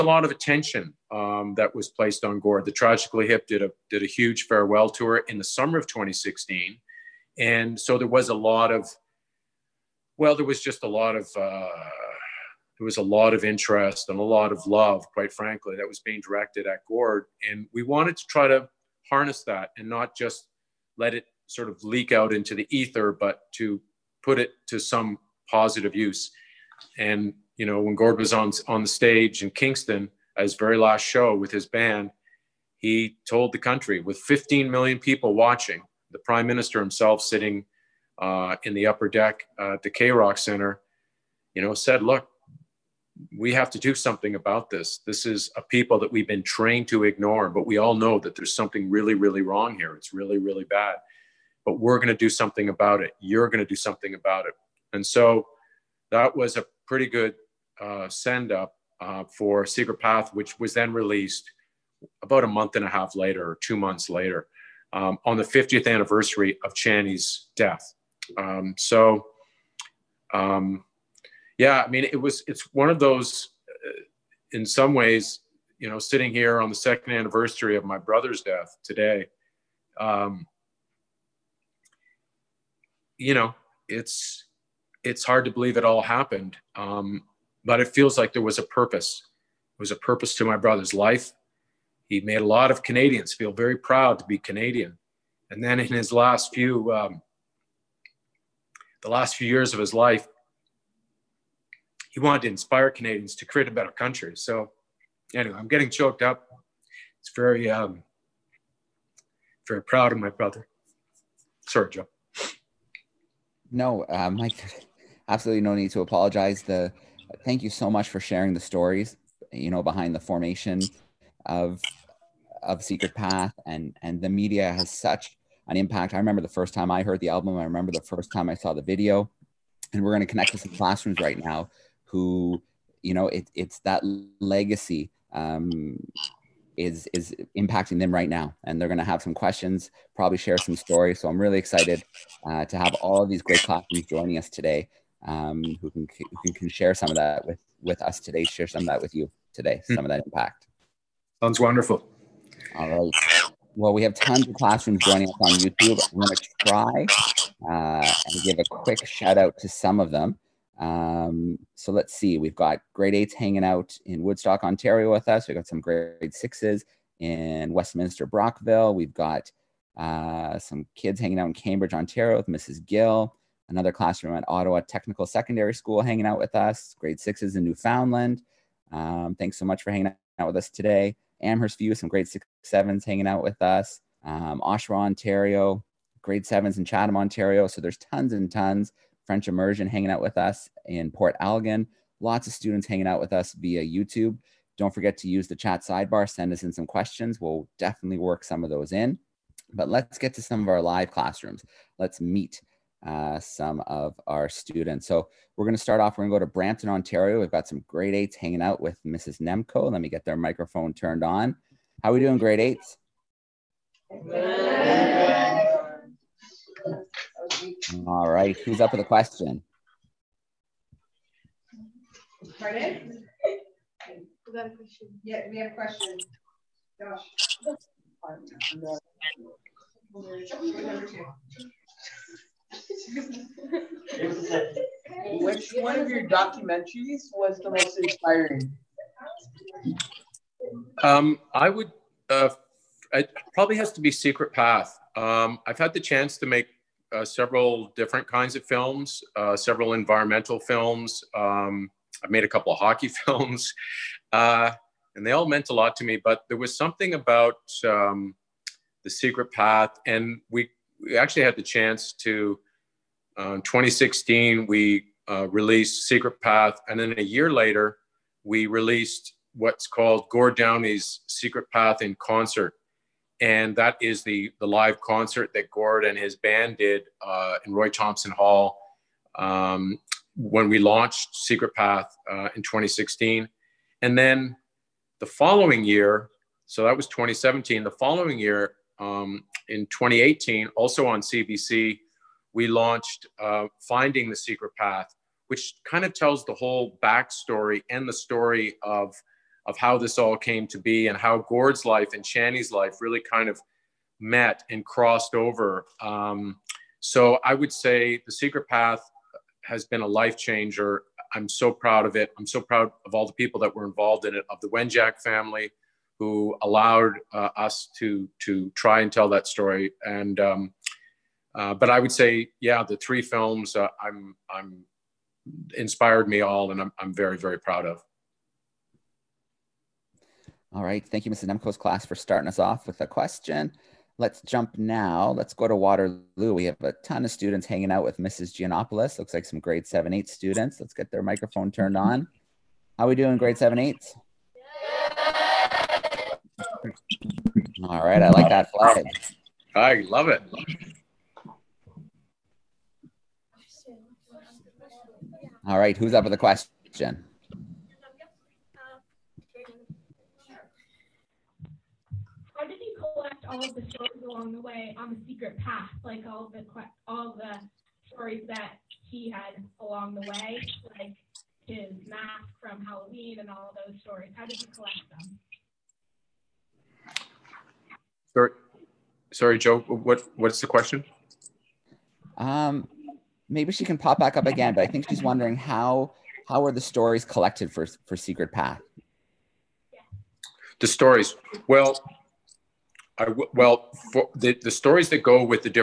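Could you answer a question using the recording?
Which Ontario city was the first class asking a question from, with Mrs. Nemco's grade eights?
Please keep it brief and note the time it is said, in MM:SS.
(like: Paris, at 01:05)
Brampton, at 03:26.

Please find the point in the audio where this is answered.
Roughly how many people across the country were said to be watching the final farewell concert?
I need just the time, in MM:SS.
00:34.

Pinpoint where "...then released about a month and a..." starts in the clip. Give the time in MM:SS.
01:00.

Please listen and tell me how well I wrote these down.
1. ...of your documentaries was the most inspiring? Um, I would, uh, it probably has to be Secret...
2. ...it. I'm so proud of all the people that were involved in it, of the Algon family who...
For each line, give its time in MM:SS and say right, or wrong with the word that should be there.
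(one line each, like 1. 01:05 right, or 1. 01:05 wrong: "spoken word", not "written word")
1. 03:55 right
2. 05:12 wrong: "Wenjack", not "Algon".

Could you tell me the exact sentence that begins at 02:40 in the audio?
Um, so let's see, we've got grade eights hanging out in Woodstock, Ontario with us.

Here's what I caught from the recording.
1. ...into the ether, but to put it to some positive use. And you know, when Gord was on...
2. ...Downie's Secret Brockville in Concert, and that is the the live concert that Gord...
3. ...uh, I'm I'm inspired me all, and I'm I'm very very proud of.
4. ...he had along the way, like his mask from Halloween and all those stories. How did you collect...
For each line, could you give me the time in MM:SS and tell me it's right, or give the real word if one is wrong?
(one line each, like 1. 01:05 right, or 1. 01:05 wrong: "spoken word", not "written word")
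1. 00:22 right
2. 04:30 wrong: "Path", not "Brockville"
3. 05:23 right
4. 06:09 right.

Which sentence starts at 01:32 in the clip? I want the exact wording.
He made a lot of Canadians feel very proud to be Canadian.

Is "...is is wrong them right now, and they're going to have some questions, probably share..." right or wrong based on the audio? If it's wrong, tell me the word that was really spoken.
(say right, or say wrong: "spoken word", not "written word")
wrong: "impacting", not "wrong".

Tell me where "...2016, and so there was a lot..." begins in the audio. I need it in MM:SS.
00:05.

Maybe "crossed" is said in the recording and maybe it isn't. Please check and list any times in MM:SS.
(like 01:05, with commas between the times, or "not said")
05:04.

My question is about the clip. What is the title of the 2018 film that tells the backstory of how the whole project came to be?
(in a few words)
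Finding the Secret Path.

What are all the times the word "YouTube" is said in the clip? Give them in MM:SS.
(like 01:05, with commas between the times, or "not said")
02:35, 03:13.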